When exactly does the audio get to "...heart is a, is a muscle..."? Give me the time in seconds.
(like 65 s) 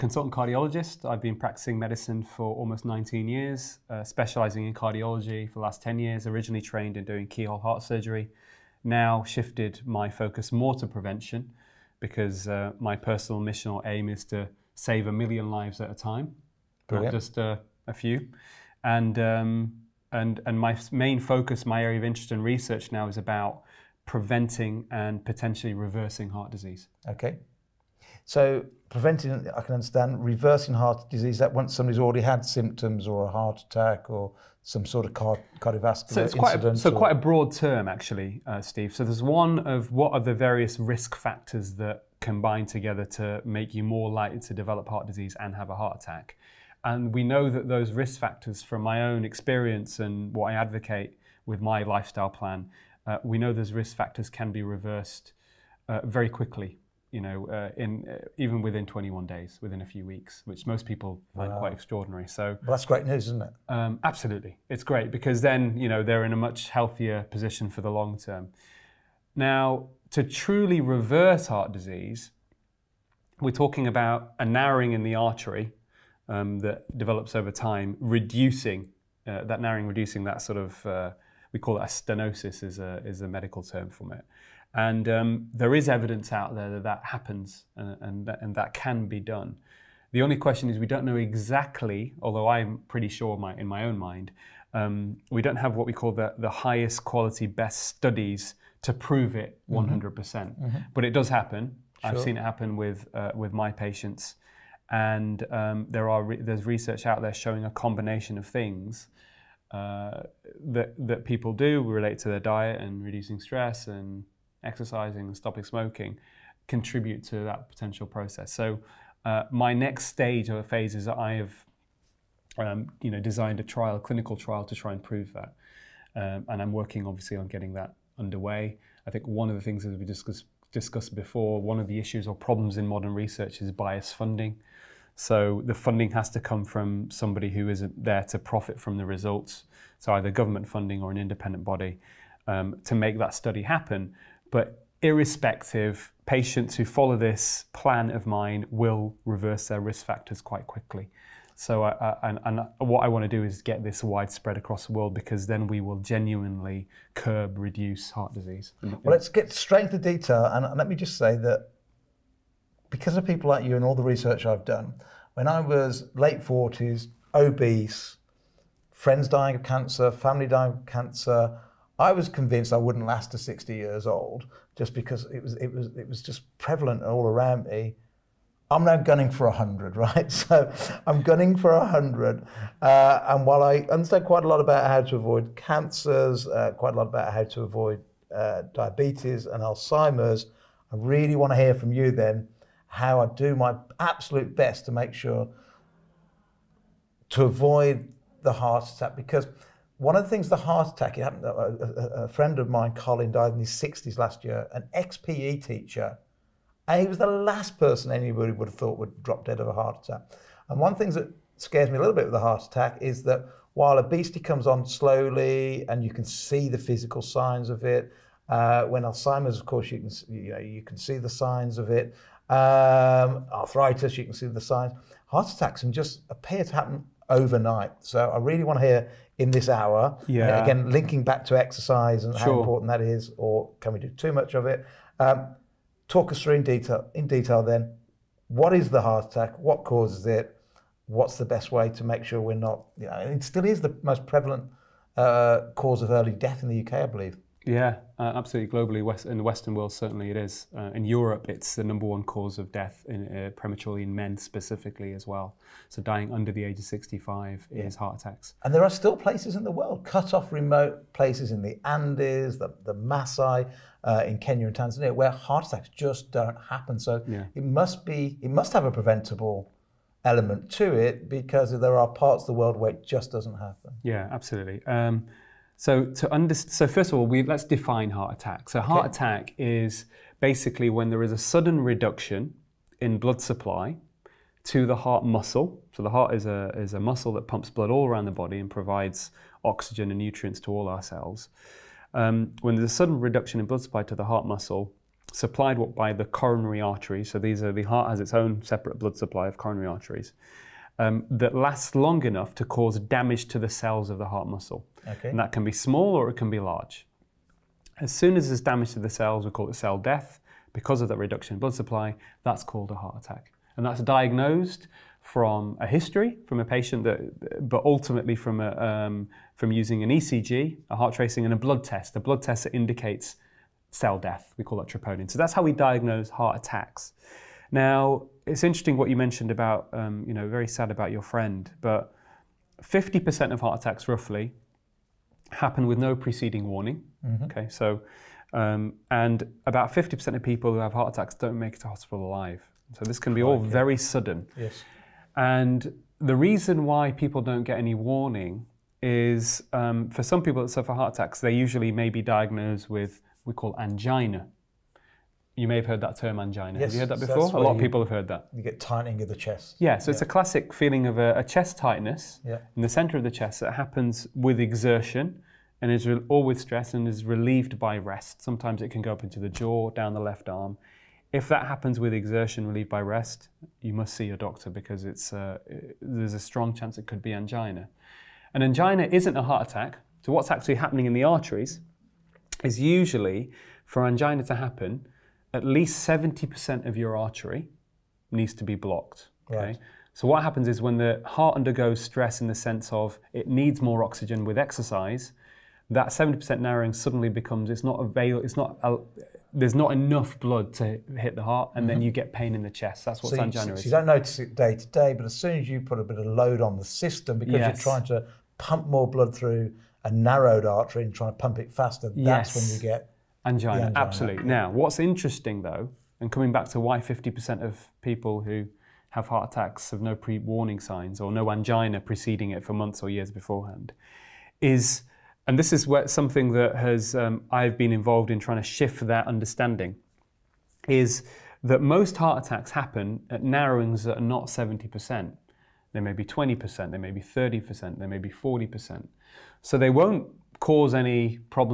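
286 s.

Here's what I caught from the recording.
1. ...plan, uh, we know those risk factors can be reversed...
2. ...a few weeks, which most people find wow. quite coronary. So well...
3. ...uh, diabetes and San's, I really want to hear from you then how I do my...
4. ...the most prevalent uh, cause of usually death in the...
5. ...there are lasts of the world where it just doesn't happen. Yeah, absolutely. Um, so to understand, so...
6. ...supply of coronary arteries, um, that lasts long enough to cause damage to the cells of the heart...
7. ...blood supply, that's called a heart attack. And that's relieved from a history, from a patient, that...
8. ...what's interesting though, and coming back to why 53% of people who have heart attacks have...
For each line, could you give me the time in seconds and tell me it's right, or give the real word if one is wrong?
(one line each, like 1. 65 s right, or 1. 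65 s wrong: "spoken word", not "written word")
1. 52 s right
2. 59 s wrong: "extraordinary", not "coronary"
3. 188 s wrong: "Alzheimer", not "San"
4. 243 s wrong: "early", not "usually"
5. 271 s wrong: "parts", not "lasts"
6. 299 s right
7. 311 s wrong: "diagnosed", not "relieved"
8. 414 s wrong: "50", not "53".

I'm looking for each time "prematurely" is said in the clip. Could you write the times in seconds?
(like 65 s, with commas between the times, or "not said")
253 s.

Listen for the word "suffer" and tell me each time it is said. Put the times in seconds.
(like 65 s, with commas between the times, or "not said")
350 s.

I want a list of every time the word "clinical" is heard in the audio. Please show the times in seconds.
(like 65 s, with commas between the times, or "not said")
123 s.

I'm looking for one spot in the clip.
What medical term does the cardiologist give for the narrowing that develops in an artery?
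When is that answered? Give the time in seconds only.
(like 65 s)
81 s.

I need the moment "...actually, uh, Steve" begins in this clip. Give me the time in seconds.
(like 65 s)
37 s.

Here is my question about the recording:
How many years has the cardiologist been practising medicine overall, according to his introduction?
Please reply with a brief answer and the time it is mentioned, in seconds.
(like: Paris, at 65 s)
19, at 2 s.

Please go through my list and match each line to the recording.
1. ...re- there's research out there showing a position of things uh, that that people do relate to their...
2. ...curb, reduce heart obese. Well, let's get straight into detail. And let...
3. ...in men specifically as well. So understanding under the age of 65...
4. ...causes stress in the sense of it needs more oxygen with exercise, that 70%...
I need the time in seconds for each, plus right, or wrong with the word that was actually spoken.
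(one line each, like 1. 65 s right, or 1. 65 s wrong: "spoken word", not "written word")
1. 106 s wrong: "combination", not "position"
2. 157 s wrong: "disease", not "obese"
3. 254 s wrong: "dying", not "understanding"
4. 391 s wrong: "undergoes", not "causes".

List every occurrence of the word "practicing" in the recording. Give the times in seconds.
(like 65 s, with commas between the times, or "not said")
1 s.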